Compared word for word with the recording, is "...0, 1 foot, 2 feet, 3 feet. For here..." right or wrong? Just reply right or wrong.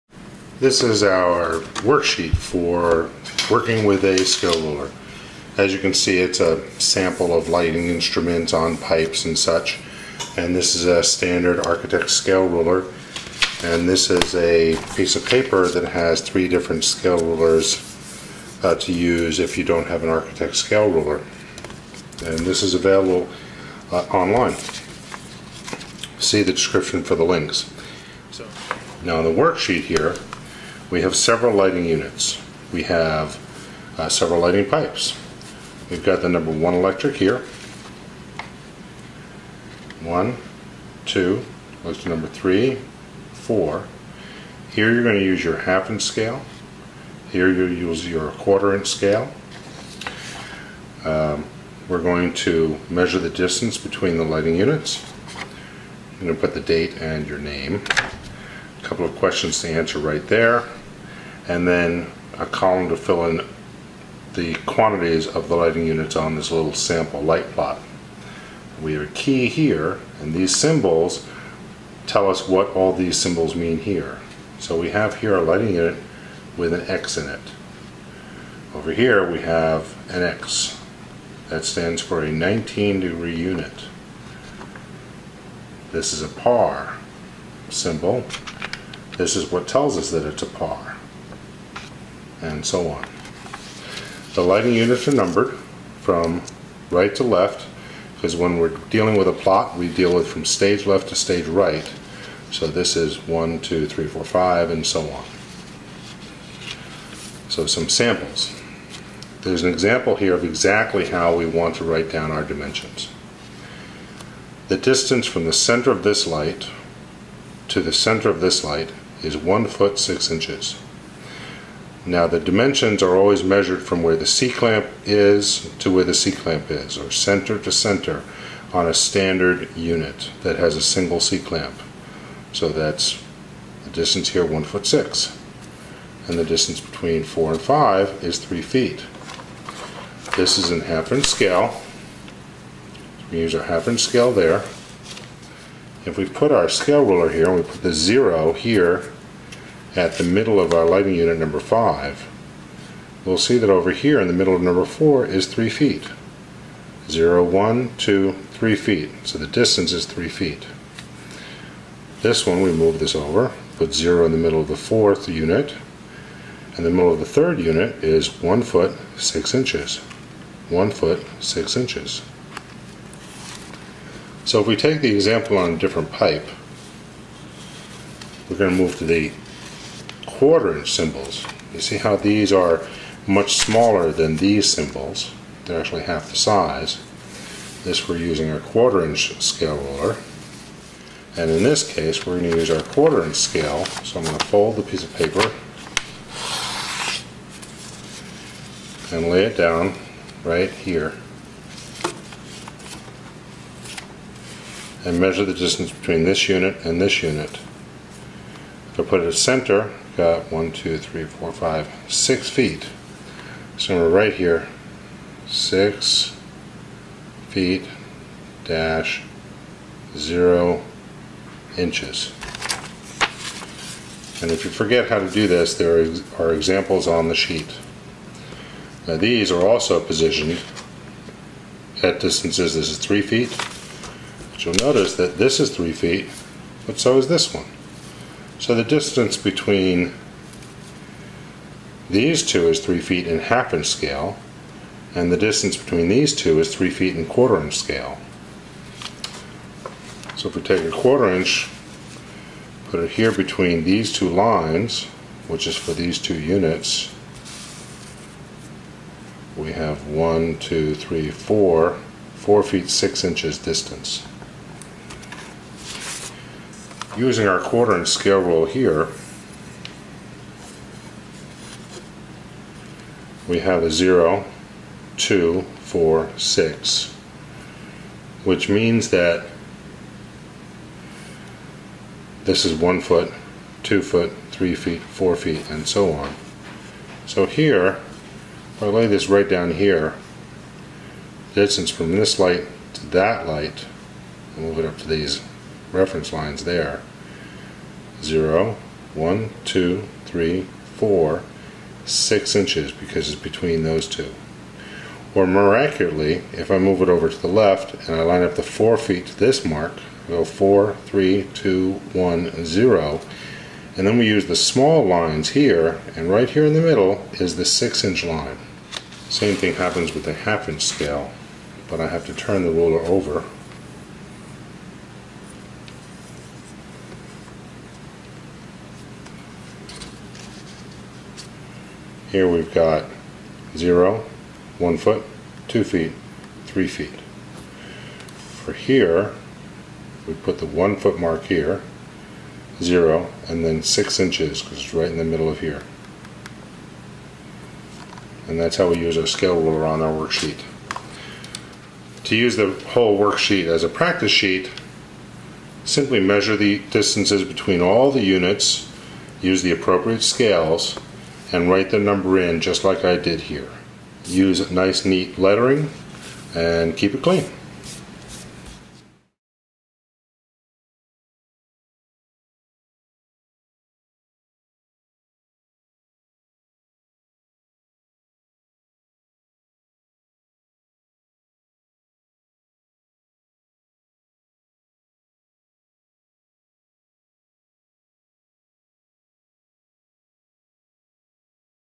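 right.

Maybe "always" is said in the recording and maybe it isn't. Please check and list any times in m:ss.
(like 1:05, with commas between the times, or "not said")
2:03.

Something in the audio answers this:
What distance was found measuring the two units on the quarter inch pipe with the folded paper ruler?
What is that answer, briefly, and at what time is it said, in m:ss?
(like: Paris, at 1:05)
6 feet 0 inches, at 3:35.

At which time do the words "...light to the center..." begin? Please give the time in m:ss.
1:56.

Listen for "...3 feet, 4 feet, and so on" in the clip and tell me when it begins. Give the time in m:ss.
4:44.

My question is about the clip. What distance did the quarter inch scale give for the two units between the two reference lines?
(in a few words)
4 feet 6 inches.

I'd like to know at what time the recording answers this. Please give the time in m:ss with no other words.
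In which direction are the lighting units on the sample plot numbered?
1:36.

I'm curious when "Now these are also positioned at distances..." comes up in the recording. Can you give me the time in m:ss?
3:49.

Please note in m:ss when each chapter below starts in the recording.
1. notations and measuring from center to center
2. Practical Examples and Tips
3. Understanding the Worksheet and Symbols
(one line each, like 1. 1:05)
1. 1:55
2. 5:25
3. 0:32.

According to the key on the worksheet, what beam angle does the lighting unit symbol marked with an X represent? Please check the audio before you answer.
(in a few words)
19 degree.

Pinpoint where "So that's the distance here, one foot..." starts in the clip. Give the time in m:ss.
2:12.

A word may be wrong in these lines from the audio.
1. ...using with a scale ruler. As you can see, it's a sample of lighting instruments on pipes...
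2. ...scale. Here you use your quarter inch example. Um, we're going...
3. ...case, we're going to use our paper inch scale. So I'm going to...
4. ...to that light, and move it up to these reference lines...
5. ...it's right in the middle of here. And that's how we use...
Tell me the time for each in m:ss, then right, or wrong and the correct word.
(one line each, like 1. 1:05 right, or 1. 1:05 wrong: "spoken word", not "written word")
1. 0:03 wrong: "working", not "using"
2. 0:46 wrong: "scale", not "example"
3. 3:11 wrong: "quarter", not "paper"
4. 4:52 right
5. 5:44 right.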